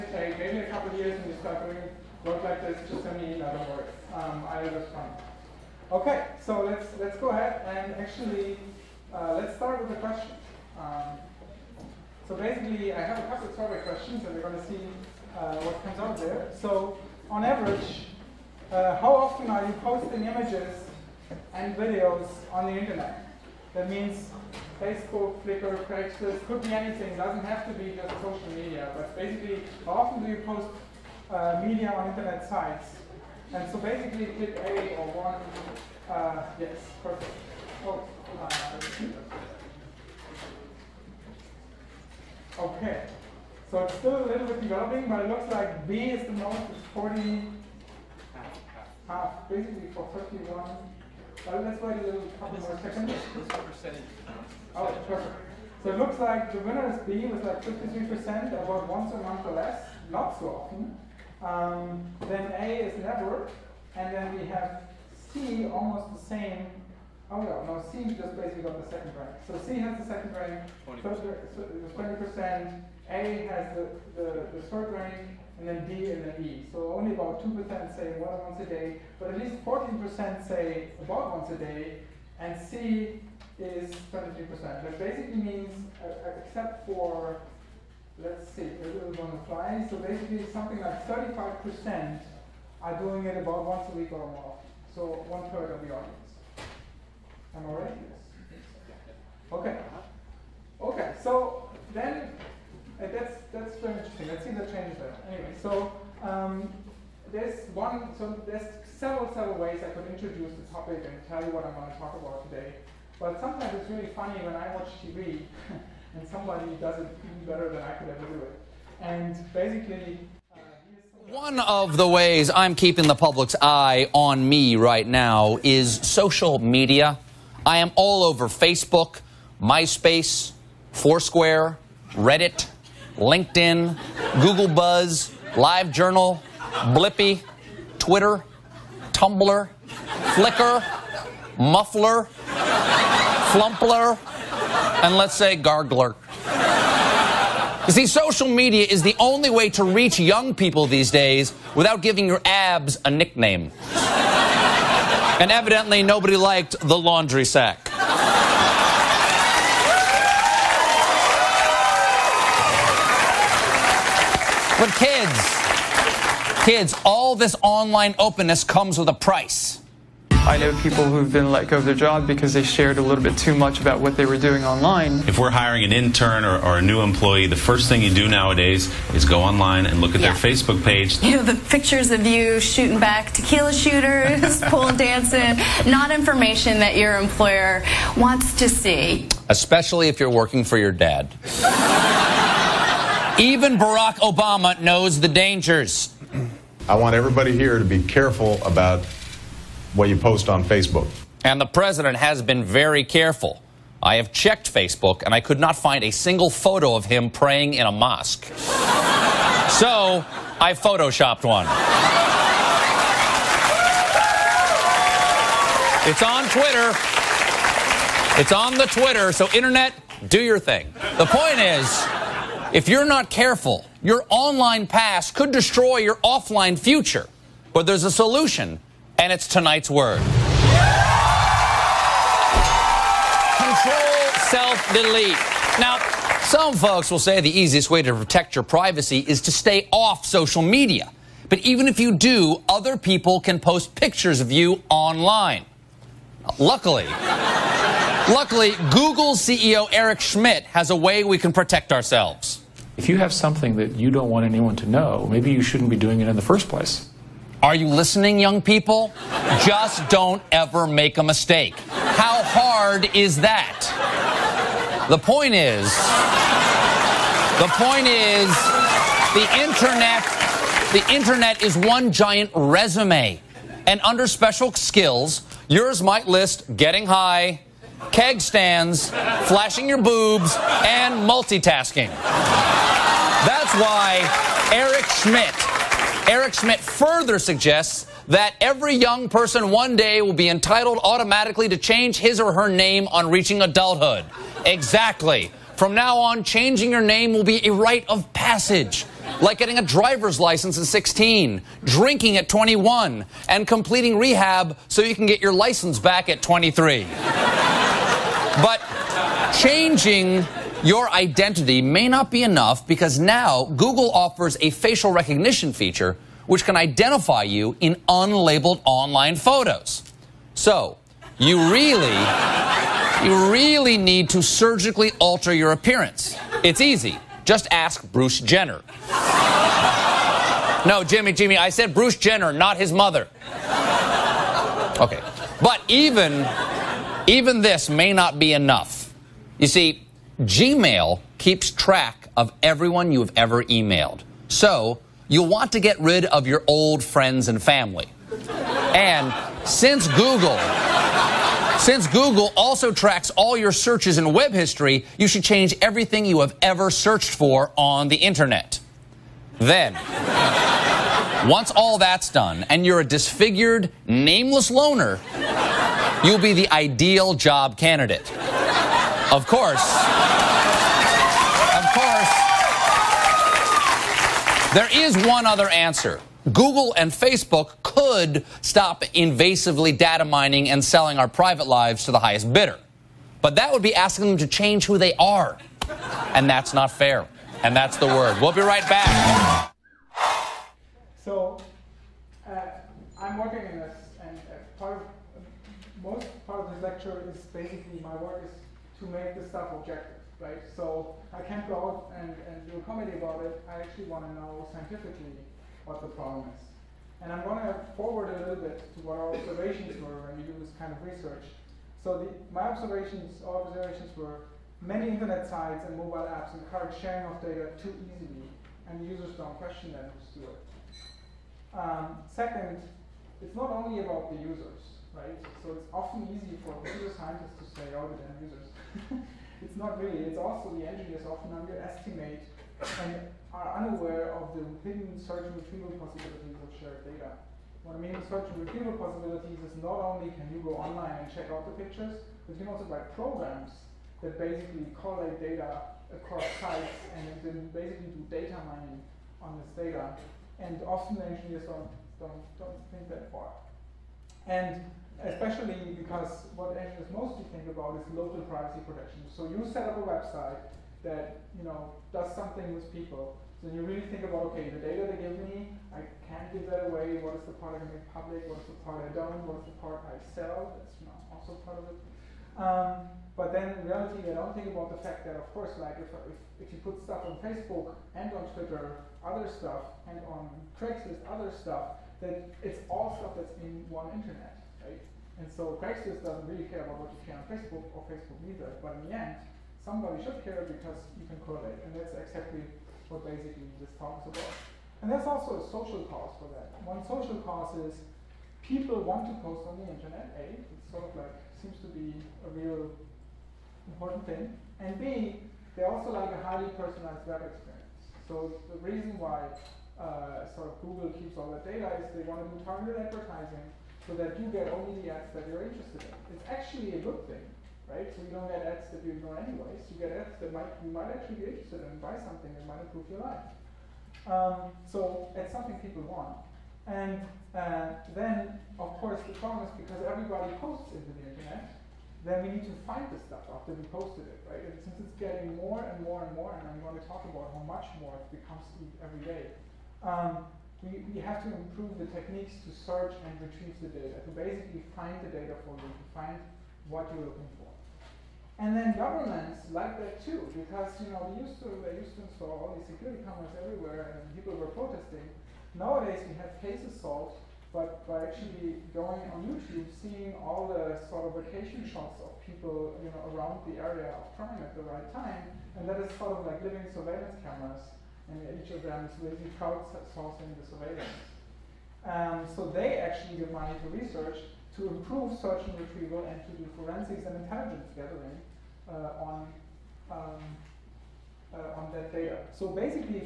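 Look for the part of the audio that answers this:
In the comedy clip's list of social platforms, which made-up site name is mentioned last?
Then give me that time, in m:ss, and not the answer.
2:25.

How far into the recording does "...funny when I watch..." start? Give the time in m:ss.
1:54.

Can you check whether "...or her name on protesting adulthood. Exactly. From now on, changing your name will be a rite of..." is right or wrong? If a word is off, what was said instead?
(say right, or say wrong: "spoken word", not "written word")
wrong: "reaching", not "protesting".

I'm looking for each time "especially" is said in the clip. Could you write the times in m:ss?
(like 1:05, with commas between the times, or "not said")
3:09, 7:35.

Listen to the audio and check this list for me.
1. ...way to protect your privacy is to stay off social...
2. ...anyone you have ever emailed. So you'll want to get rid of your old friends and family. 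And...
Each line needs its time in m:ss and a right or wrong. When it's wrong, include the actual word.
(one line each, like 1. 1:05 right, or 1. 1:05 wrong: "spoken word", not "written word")
1. 3:57 right
2. 5:42 wrong: "everyone", not "anyone".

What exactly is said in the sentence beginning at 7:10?
It's also the engineers often underestimate and are unaware of the hidden search and retrieval possibilities of shared data.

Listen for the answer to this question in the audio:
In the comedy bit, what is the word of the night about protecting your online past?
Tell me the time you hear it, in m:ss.
3:53.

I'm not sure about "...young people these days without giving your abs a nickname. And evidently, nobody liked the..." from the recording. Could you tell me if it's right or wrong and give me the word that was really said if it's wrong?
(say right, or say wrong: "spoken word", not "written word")
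right.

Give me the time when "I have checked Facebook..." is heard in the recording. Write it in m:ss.
3:24.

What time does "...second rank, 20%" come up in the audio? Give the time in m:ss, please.
1:10.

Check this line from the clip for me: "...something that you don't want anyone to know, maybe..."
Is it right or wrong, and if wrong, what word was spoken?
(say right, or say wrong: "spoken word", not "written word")
right.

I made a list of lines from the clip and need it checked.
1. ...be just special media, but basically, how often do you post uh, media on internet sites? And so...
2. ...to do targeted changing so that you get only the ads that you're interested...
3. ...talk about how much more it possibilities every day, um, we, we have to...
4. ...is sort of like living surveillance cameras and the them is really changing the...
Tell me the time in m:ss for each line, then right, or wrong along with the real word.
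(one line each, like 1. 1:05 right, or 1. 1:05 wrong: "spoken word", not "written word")
1. 0:27 wrong: "social", not "special"
2. 8:32 wrong: "advertising", not "changing"
3. 8:57 wrong: "becomes", not "possibilities"
4. 9:25 wrong: "crowdsourcing", not "changing".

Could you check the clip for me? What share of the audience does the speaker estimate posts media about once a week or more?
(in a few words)
35%.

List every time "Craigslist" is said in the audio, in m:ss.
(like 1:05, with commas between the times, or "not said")
0:25, 8:00, 8:05.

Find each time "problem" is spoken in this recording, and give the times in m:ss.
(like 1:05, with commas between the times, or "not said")
6:46, 8:49.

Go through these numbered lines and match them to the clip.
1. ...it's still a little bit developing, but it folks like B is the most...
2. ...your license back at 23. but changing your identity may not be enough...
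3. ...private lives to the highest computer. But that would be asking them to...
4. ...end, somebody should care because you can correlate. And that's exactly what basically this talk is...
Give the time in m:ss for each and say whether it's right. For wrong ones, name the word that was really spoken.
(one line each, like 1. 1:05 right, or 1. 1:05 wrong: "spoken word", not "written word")
1. 0:43 wrong: "looks", not "folks"
2. 5:05 right
3. 6:21 wrong: "bidder", not "computer"
4. 8:09 right.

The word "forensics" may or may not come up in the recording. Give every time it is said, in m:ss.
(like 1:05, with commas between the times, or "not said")
9:36.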